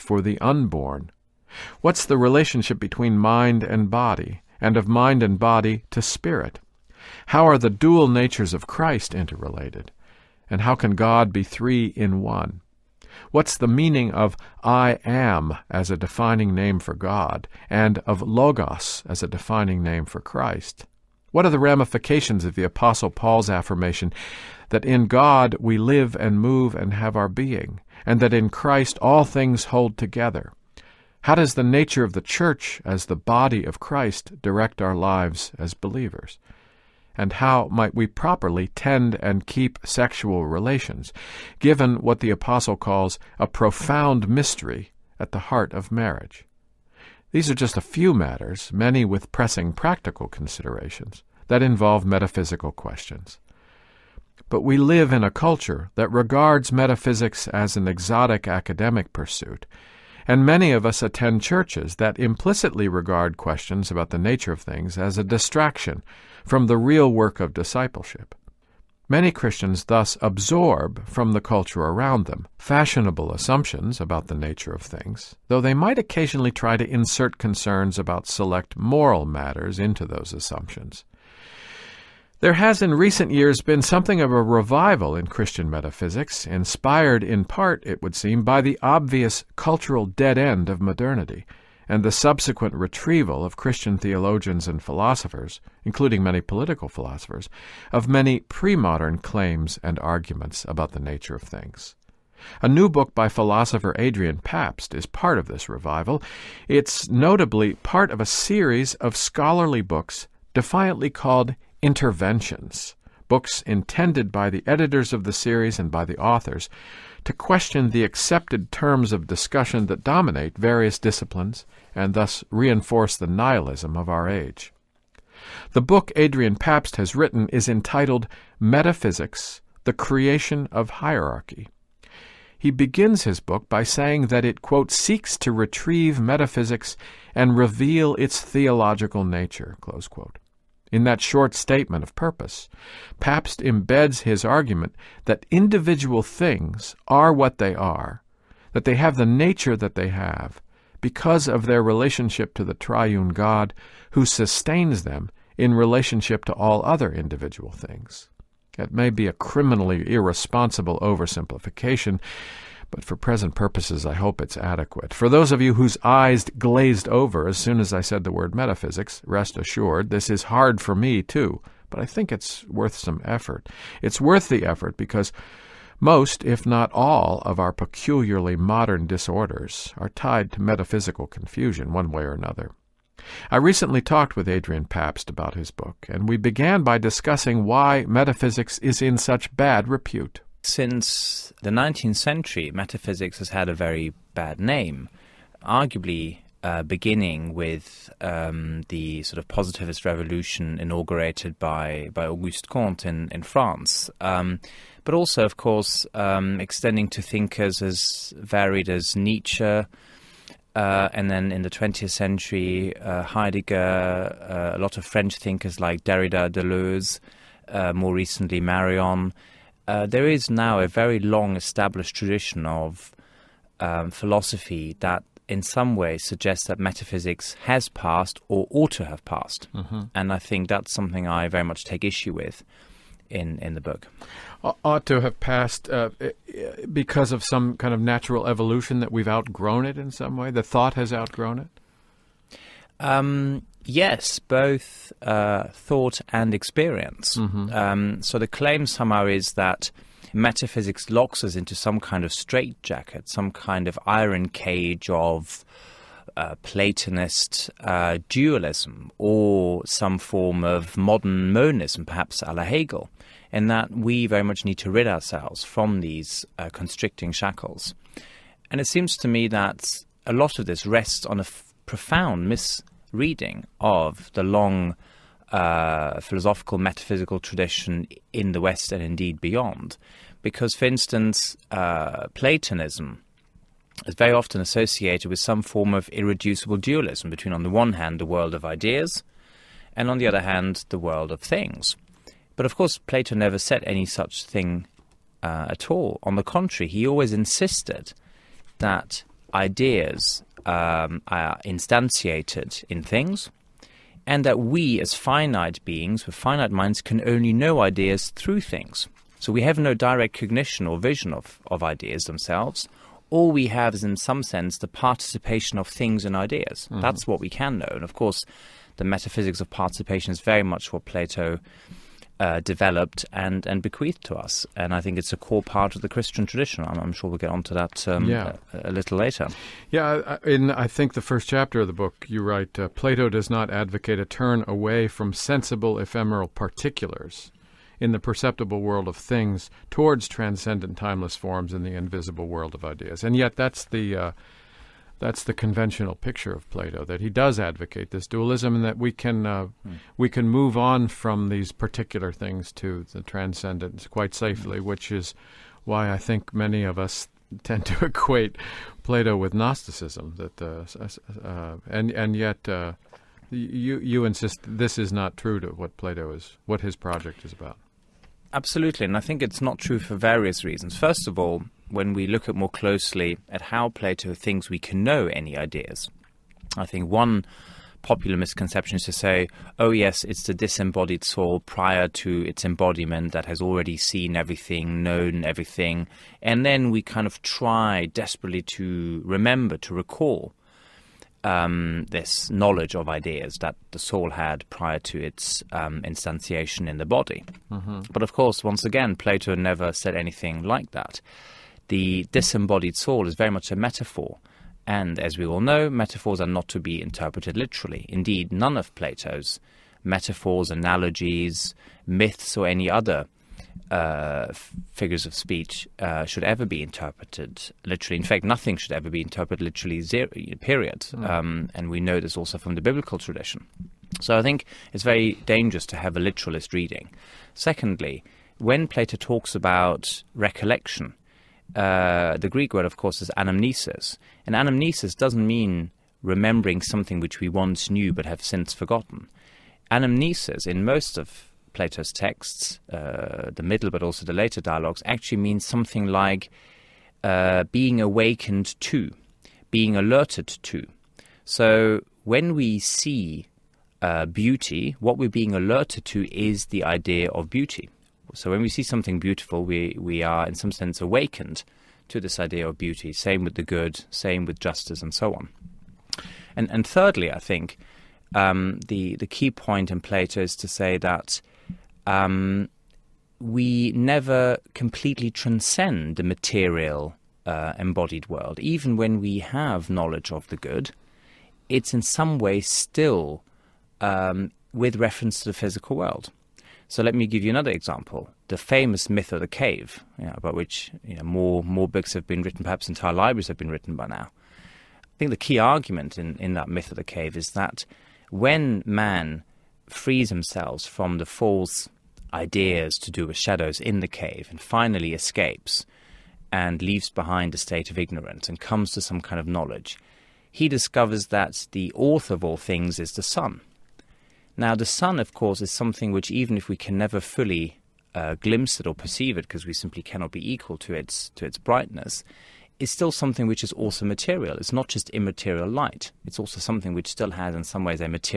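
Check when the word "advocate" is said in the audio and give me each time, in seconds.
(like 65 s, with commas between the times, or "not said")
333 s, 347 s.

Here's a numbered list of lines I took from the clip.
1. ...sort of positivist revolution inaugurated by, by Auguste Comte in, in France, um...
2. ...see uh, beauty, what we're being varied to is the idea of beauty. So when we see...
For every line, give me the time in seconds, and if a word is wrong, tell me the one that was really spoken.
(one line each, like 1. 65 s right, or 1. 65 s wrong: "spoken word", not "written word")
1. 199 s right
2. 452 s wrong: "alerted", not "varied".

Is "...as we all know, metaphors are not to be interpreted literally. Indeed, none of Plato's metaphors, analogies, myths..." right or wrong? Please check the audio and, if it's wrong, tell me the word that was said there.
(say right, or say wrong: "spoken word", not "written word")
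right.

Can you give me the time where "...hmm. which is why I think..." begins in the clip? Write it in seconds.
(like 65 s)
354 s.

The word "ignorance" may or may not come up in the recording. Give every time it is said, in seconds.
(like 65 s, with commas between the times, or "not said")
507 s.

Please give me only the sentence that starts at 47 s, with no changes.
These are just a few matters, many with pressing practical considerations, that involve metaphysical questions.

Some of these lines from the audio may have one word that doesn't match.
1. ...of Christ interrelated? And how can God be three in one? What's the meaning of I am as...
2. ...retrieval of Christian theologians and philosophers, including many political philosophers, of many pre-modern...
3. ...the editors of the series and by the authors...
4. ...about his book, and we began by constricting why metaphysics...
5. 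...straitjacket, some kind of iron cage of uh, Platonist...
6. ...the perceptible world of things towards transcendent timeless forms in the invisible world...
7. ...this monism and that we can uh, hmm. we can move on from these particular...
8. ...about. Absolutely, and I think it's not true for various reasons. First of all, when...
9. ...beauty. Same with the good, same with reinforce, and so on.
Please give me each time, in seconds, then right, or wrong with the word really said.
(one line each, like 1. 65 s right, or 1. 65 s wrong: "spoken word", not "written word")
1. 8 s right
2. 92 s right
3. 114 s right
4. 185 s wrong: "discussing", not "constricting"
5. 252 s right
6. 338 s right
7. 348 s wrong: "dualism", not "monism"
8. 367 s right
9. 462 s wrong: "justice", not "reinforce".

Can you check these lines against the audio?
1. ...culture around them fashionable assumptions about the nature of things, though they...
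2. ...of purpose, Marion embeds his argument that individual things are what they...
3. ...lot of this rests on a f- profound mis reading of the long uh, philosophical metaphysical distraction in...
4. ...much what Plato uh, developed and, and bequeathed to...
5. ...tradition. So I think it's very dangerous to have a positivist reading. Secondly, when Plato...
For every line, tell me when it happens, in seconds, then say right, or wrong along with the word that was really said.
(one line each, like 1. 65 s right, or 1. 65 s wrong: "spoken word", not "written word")
1. 71 s right
2. 142 s wrong: "Pabst", not "Marion"
3. 270 s wrong: "tradition", not "distraction"
4. 320 s right
5. 423 s wrong: "literalist", not "positivist".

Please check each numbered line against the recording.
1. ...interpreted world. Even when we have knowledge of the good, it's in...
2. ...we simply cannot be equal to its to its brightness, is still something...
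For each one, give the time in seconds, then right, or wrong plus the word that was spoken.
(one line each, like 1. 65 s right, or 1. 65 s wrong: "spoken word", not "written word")
1. 477 s wrong: "embodied", not "interpreted"
2. 519 s right.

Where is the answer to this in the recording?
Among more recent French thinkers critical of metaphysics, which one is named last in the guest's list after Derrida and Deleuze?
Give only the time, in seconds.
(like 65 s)
218 s.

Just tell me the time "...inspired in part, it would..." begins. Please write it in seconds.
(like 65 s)
86 s.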